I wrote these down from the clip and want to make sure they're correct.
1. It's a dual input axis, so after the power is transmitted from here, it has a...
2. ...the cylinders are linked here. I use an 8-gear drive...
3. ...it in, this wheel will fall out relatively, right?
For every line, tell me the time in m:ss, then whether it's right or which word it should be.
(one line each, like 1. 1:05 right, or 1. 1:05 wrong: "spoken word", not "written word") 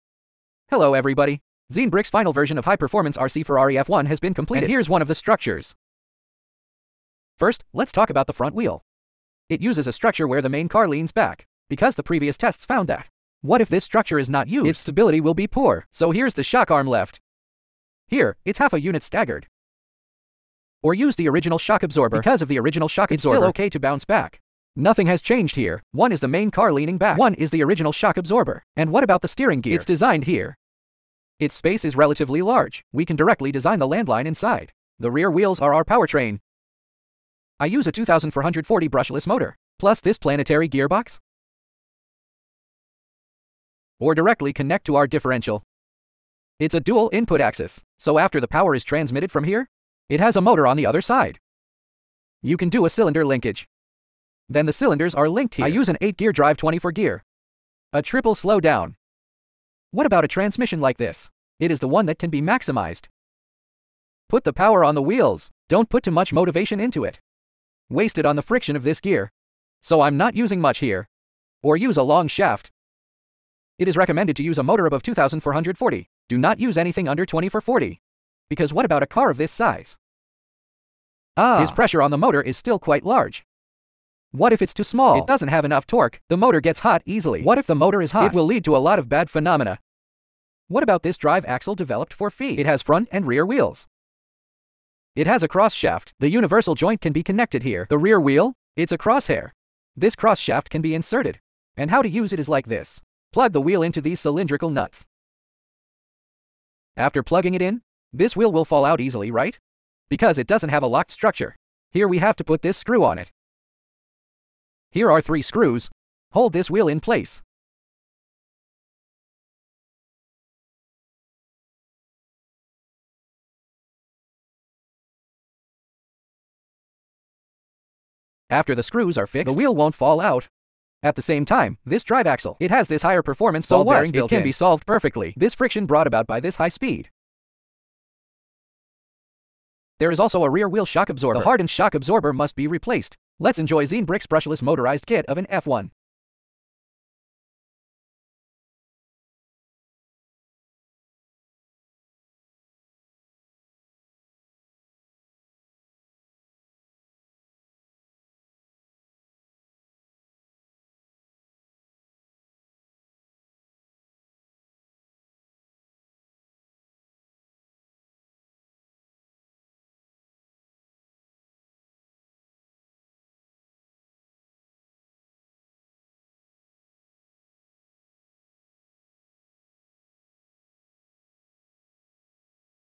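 1. 0:46 right
2. 0:54 right
3. 1:47 wrong: "easily", not "relatively".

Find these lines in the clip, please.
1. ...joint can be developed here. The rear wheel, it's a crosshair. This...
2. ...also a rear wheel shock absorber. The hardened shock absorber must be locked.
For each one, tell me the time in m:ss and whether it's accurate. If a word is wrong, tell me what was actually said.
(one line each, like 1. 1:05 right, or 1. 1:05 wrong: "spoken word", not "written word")
1. 1:36 wrong: "connected", not "developed"
2. 2:20 wrong: "replaced", not "locked".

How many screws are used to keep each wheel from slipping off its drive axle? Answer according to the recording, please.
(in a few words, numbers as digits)
3.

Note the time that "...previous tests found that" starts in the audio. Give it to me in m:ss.
0:12.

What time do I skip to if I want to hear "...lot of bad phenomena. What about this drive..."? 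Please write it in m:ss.
1:28.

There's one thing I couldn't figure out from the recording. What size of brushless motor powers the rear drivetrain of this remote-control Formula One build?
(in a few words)
2440.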